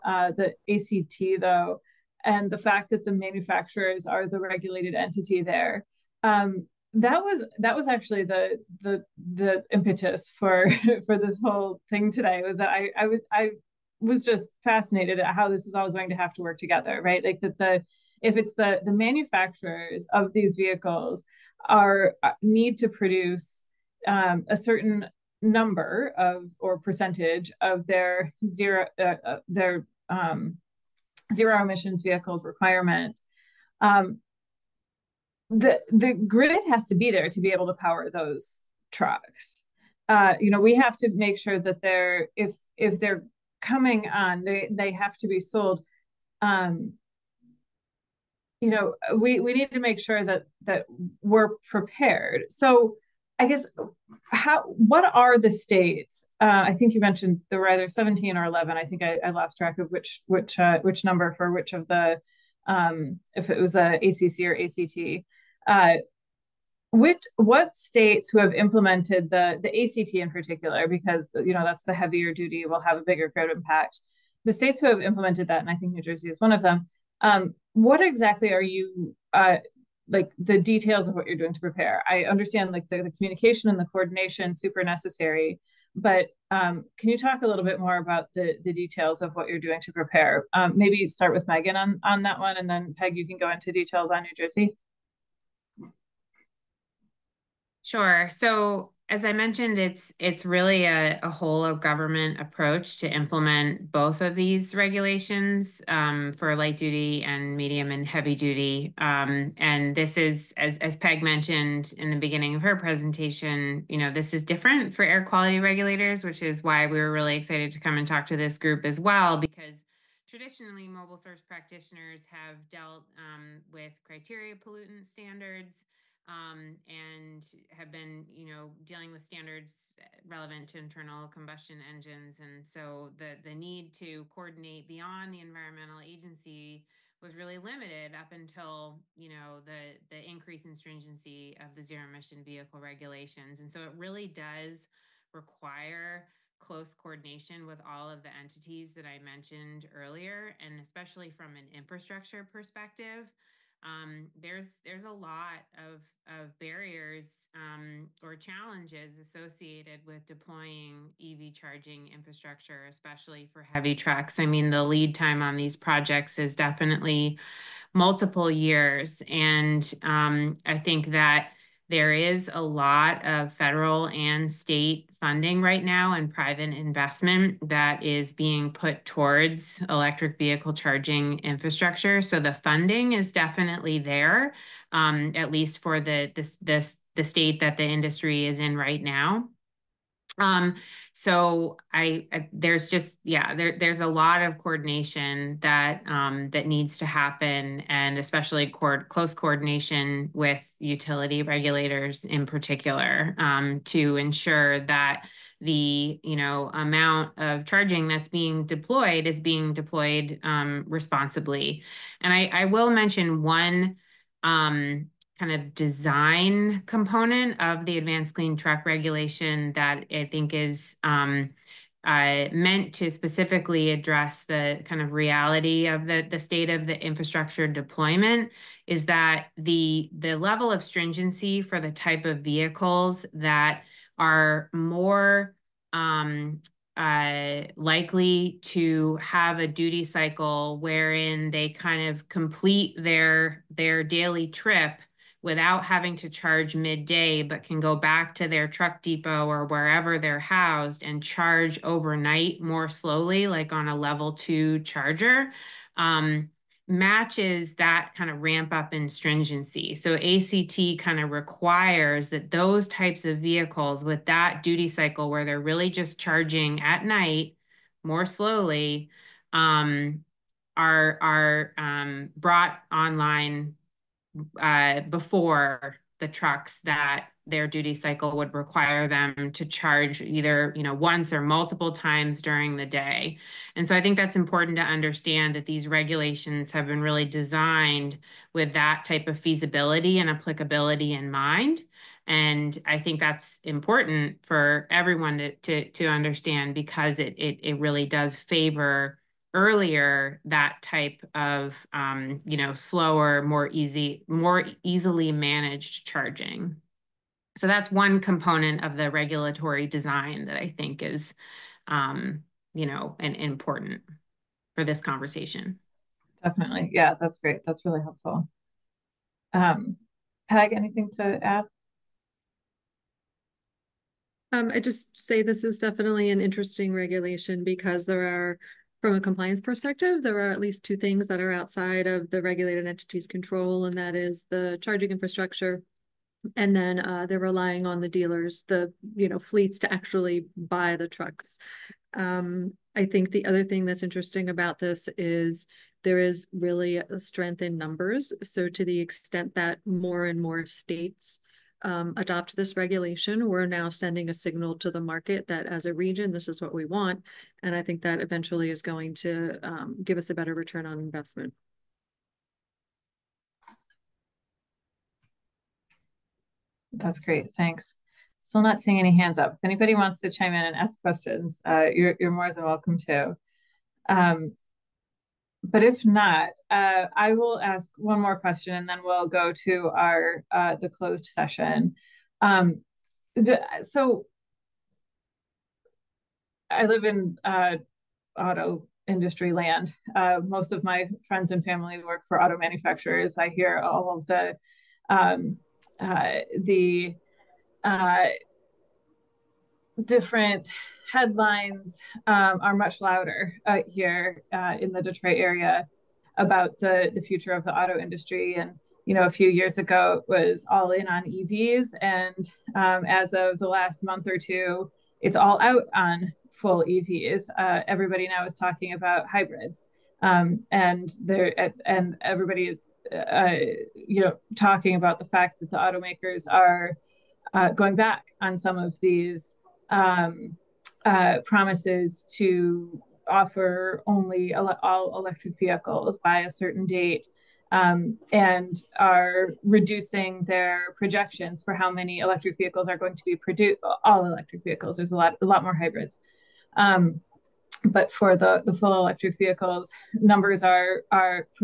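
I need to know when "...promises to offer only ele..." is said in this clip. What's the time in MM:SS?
07:11.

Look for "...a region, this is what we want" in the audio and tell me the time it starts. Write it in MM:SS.
05:55.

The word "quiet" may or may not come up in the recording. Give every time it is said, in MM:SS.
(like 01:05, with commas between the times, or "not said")
not said.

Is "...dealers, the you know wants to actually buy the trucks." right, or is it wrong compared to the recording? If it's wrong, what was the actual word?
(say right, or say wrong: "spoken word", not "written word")
wrong: "fleets", not "wants".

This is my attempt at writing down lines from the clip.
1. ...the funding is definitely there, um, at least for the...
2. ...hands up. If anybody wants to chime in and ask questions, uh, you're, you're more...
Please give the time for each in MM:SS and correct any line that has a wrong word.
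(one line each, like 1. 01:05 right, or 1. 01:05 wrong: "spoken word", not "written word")
1. 03:02 right
2. 06:09 right.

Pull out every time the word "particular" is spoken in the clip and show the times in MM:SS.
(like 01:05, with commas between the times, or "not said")
01:10, 03:22.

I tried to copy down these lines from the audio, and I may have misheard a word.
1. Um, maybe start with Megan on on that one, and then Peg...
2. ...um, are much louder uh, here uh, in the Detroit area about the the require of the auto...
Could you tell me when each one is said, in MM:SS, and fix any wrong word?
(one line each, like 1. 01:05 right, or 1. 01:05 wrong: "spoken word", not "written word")
1. 01:30 right
2. 06:42 wrong: "future", not "require".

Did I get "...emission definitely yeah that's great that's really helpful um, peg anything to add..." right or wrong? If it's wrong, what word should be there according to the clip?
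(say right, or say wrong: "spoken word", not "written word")
wrong: "conversation", not "emission".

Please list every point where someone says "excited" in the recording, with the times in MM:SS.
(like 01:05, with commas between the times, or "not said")
01:57.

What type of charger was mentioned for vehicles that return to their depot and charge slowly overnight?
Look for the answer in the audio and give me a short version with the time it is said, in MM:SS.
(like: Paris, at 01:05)
Level two charger, at 04:13.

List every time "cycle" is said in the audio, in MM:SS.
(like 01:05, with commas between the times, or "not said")
04:00, 04:24, 04:37.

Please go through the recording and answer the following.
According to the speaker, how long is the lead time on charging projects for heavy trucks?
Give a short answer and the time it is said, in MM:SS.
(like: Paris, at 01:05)
Multiple years, at 02:47.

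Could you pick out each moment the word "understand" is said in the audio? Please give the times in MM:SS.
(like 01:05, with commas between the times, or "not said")
01:22, 04:44, 04:56.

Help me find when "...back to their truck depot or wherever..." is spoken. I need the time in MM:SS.
04:07.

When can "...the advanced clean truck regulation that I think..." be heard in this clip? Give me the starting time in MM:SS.
03:37.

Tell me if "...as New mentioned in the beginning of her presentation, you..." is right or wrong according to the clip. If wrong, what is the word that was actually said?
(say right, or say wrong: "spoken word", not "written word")
wrong: "Peg", not "New".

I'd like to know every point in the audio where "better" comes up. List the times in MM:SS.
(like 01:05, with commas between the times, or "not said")
06:00.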